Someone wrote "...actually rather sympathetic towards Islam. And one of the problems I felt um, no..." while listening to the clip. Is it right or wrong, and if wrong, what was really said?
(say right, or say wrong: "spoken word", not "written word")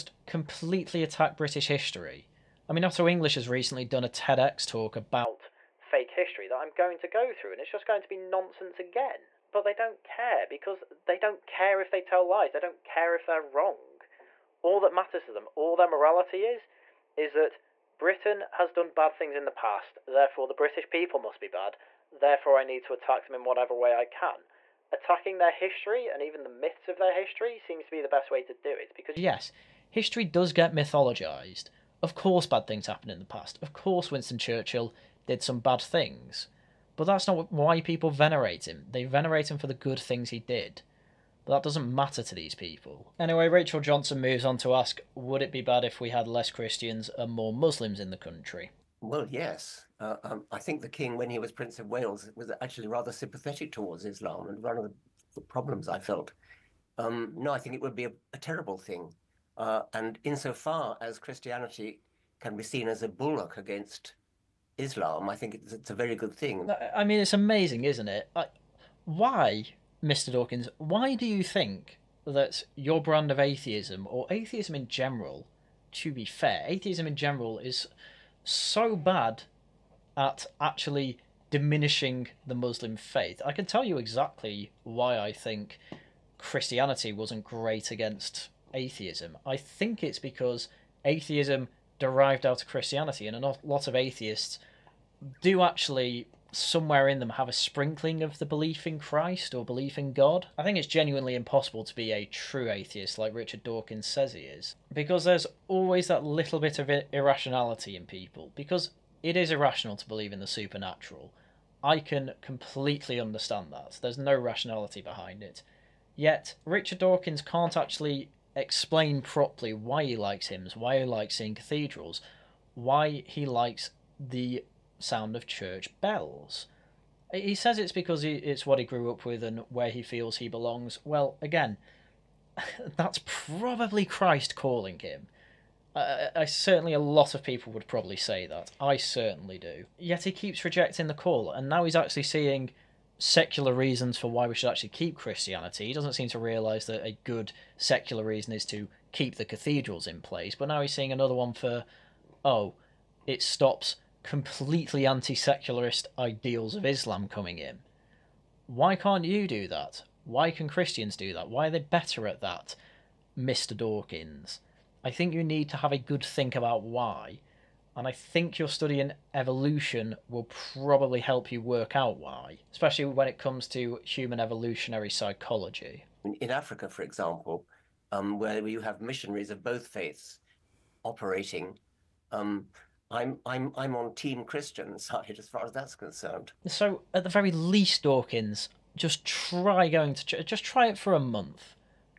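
right.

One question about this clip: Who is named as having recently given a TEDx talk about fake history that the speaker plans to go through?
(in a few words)
Otto English.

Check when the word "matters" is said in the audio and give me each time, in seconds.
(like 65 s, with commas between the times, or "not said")
14 s, 41 s.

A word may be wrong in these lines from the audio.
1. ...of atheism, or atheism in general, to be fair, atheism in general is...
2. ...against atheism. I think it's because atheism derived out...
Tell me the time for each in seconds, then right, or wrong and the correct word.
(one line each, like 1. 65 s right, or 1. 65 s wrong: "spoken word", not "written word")
1. 73 s right
2. 87 s right.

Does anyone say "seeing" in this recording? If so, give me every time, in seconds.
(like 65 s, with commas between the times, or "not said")
121 s, 142 s, 150 s.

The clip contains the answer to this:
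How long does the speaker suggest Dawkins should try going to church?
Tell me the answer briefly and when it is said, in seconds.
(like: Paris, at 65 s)
a month, at 191 s.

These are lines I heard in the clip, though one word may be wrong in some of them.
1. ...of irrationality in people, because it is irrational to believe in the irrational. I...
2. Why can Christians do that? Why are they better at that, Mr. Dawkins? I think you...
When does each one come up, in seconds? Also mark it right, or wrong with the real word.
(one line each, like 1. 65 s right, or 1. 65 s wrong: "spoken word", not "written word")
1. 106 s wrong: "supernatural", not "irrational"
2. 160 s right.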